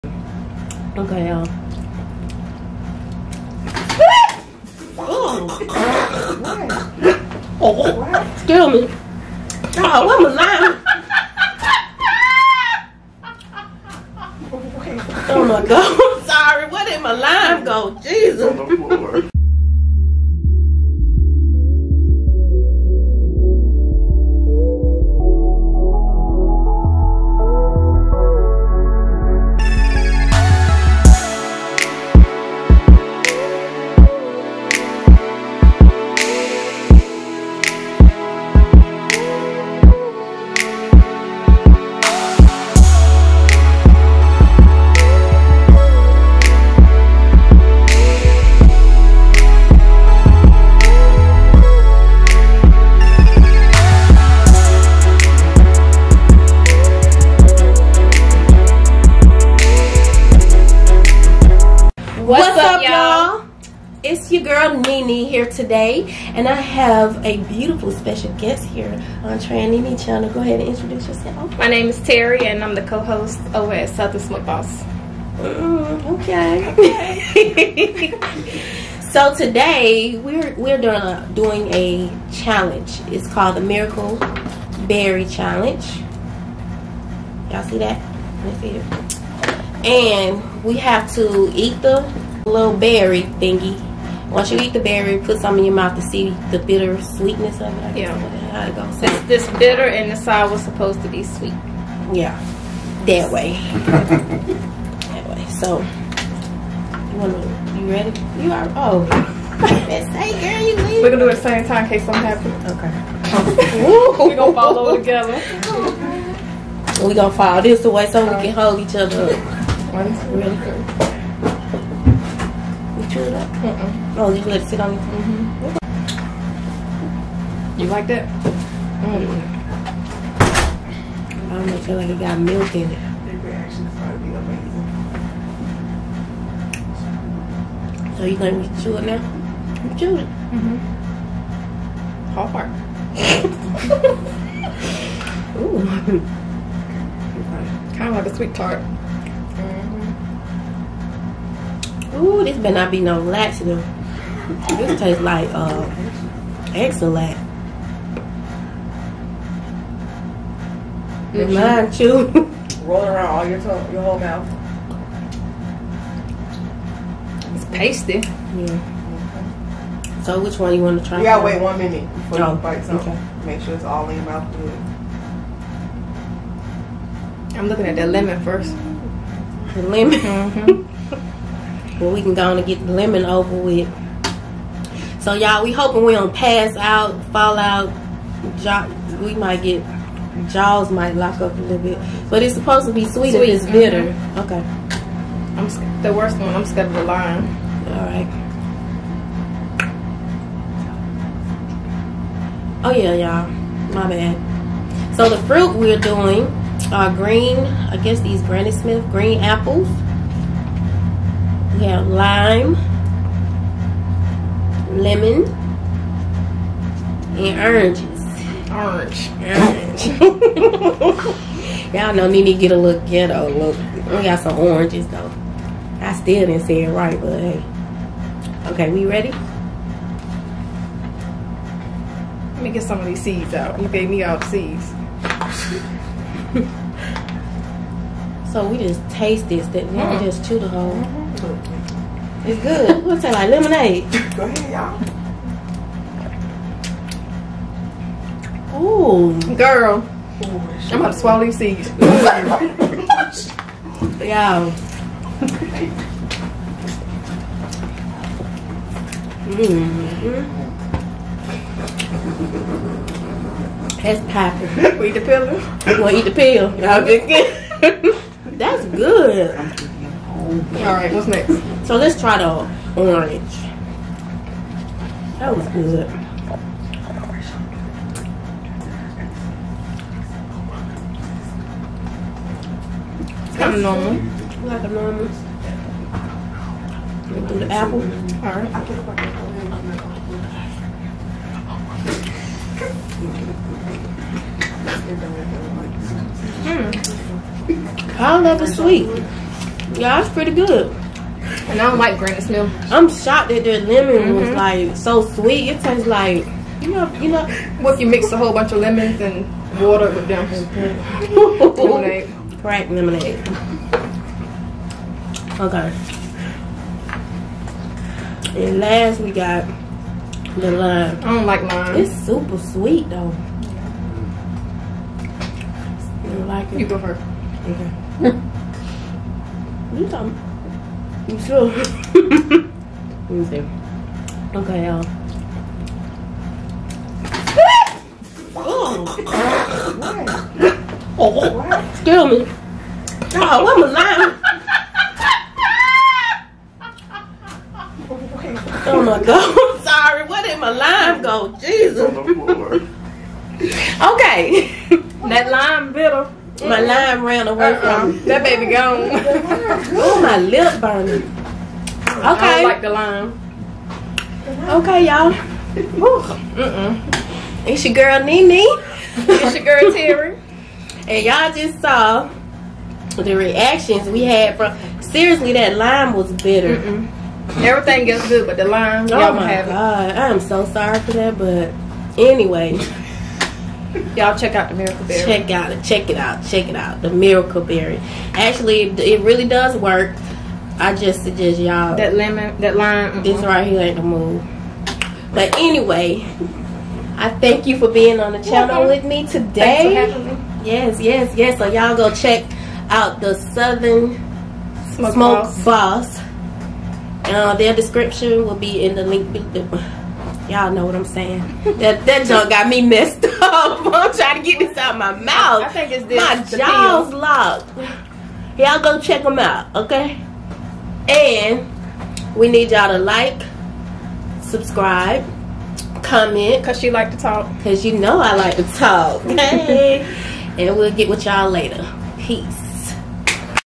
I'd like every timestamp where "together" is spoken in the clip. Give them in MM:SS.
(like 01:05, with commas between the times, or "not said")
01:54.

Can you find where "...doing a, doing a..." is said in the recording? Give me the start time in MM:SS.
01:20.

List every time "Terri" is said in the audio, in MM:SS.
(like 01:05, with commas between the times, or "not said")
01:11, 06:09.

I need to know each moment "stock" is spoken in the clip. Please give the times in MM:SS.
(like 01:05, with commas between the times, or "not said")
not said.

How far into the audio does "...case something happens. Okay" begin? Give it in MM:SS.
01:51.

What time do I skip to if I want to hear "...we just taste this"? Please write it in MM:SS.
03:58.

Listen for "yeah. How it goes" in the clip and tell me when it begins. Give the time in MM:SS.
01:37.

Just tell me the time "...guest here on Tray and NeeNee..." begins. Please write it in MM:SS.
01:08.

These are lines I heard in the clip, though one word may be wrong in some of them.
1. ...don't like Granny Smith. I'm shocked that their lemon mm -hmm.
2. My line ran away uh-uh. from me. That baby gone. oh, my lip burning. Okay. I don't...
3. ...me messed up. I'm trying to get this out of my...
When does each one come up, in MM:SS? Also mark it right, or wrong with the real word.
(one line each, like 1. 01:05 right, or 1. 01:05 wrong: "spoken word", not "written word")
1. 05:01 right
2. 05:56 right
3. 06:52 right.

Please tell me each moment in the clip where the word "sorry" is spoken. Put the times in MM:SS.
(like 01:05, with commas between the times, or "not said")
00:16, 05:49, 06:20.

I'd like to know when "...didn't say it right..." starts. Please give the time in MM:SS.
03:46.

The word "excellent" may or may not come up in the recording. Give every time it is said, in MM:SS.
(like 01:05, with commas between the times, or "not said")
02:36.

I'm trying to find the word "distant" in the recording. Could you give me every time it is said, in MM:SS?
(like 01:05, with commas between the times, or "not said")
not said.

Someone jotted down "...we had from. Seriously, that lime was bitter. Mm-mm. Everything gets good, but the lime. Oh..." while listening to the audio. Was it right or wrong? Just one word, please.
right.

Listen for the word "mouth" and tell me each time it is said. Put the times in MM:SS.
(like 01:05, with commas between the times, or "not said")
01:35, 02:44, 02:54, 06:55.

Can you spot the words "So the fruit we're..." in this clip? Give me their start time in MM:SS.
03:25.